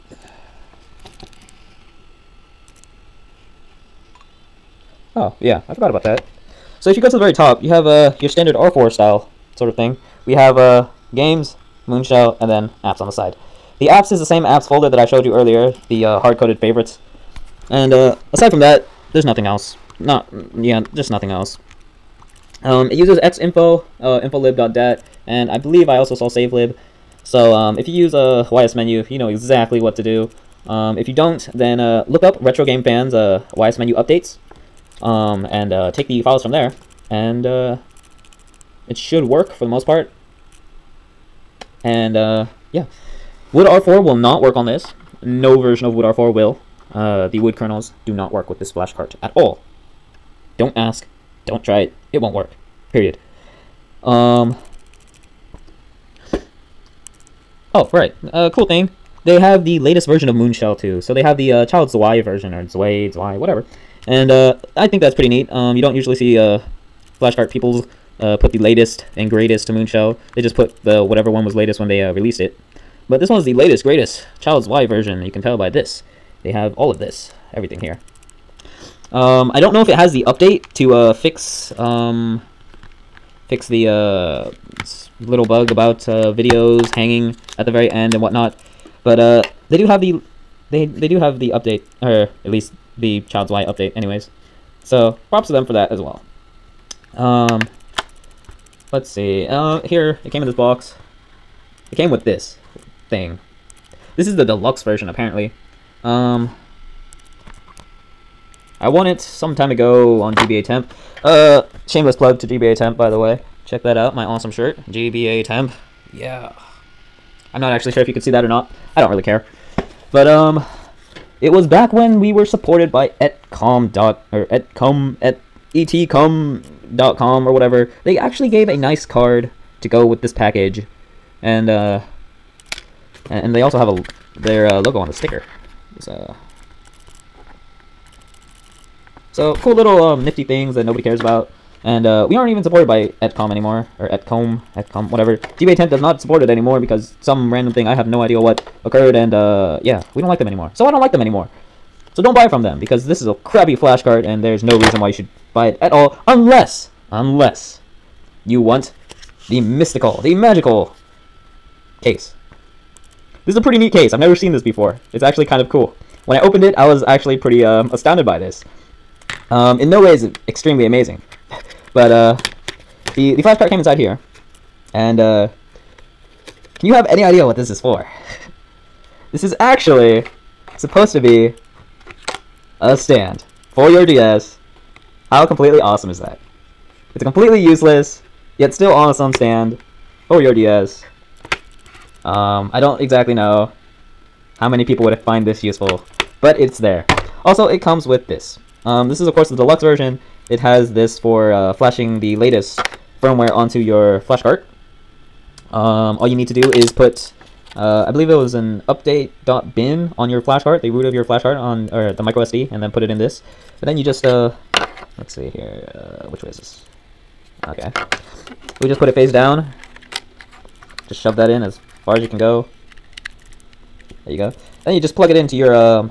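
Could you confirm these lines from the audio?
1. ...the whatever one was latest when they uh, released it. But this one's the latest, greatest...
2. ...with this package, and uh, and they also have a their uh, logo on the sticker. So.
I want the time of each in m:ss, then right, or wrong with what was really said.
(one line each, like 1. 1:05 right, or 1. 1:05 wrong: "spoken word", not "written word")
1. 1:10 right
2. 2:10 right.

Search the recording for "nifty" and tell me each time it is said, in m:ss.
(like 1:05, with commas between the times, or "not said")
2:20.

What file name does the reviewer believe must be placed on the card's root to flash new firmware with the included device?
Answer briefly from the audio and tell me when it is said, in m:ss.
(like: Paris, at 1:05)
update.bin, at 3:28.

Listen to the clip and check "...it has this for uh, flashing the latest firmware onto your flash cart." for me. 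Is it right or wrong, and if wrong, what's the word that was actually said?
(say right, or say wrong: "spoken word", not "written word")
right.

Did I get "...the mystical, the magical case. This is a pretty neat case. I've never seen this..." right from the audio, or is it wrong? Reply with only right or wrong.
right.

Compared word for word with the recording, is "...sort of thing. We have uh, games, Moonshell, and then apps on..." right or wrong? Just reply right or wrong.
right.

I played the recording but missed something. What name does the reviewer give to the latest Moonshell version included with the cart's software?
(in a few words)
Child Zwei.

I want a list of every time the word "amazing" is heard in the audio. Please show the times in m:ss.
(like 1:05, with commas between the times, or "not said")
2:50.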